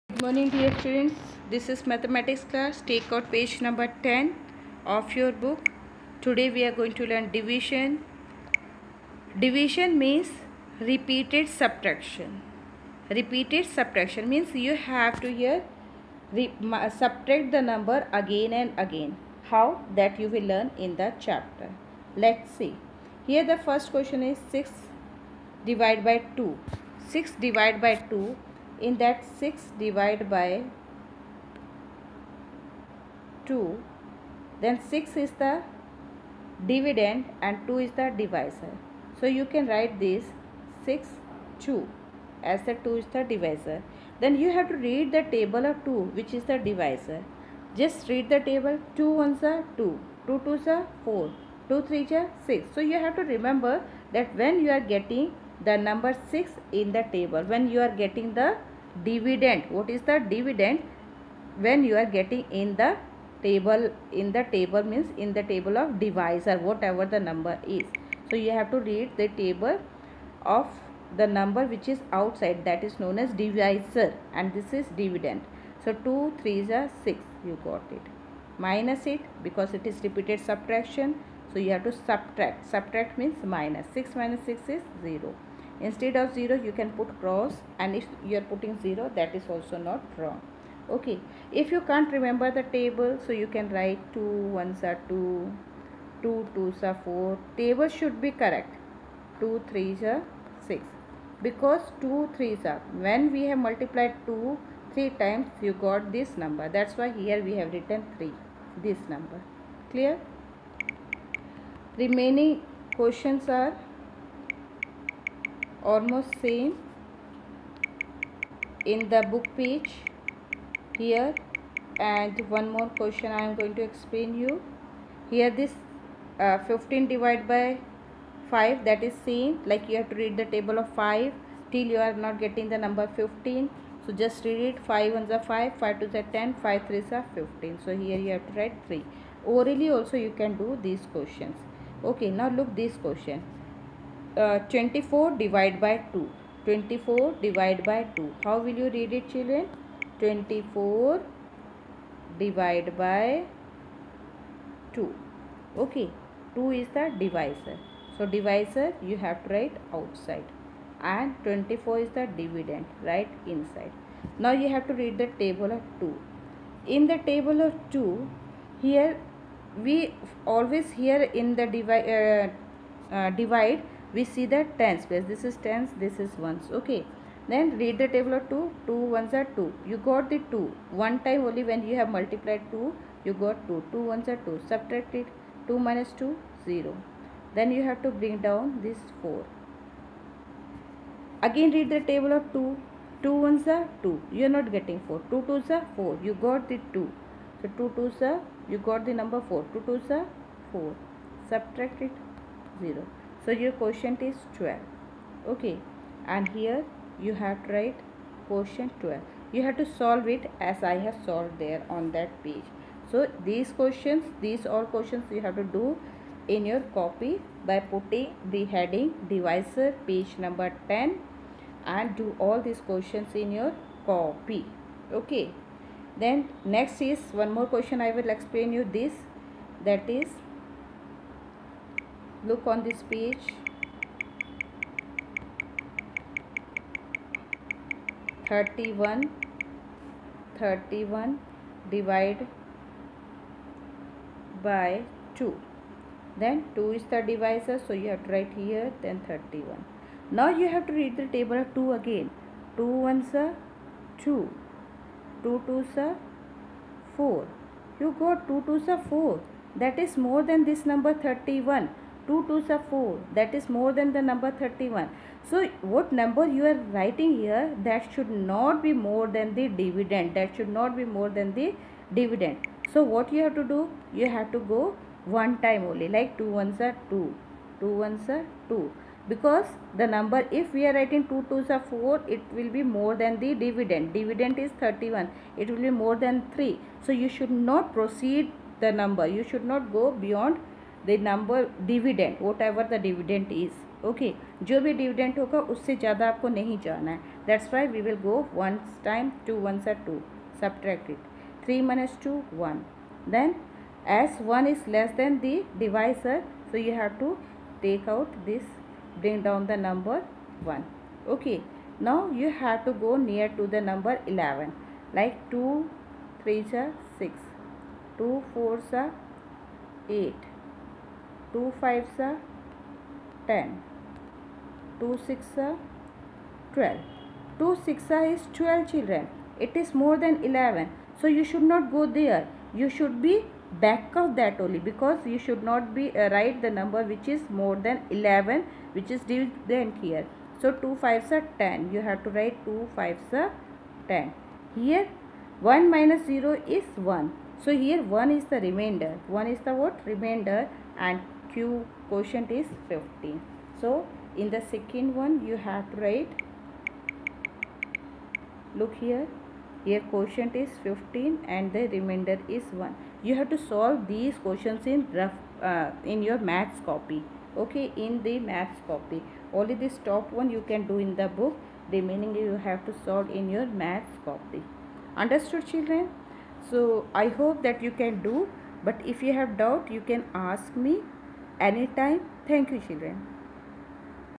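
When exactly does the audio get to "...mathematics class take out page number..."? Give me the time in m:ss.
0:01.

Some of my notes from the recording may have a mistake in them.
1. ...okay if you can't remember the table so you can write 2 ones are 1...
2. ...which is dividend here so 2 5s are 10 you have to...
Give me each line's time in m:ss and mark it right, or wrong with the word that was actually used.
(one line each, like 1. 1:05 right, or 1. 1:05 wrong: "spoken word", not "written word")
1. 1:30 wrong: "2", not "1"
2. 5:38 right.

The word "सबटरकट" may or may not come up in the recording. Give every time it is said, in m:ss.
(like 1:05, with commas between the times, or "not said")
5:00.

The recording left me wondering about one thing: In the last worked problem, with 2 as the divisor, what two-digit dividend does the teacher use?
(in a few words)
31.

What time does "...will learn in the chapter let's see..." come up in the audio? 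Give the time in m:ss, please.
0:20.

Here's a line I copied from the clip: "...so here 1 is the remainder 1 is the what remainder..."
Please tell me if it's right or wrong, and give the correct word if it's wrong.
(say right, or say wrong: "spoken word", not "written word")
right.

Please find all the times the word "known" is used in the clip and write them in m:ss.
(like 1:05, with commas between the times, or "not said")
1:12.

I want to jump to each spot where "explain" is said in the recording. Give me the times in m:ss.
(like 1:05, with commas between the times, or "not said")
2:03, 3:48.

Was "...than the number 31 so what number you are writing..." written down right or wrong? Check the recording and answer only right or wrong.
right.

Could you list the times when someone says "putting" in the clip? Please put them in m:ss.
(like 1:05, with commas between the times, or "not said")
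1:28, 3:37.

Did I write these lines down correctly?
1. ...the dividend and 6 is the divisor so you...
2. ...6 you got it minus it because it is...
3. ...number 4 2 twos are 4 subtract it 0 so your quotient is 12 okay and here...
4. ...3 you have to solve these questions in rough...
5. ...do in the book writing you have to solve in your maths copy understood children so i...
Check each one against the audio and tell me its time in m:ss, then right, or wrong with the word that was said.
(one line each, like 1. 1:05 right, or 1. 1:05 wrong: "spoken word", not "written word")
1. 0:35 wrong: "2", not "6"
2. 1:17 right
3. 3:19 right
4. 6:02 wrong: "1", not "3"
5. 6:10 wrong: "remaining", not "writing".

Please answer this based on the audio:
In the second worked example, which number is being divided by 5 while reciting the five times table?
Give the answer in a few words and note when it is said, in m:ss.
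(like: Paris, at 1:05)
15, at 2:06.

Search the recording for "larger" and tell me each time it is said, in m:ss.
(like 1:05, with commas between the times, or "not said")
not said.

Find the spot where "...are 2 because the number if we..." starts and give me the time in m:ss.
4:38.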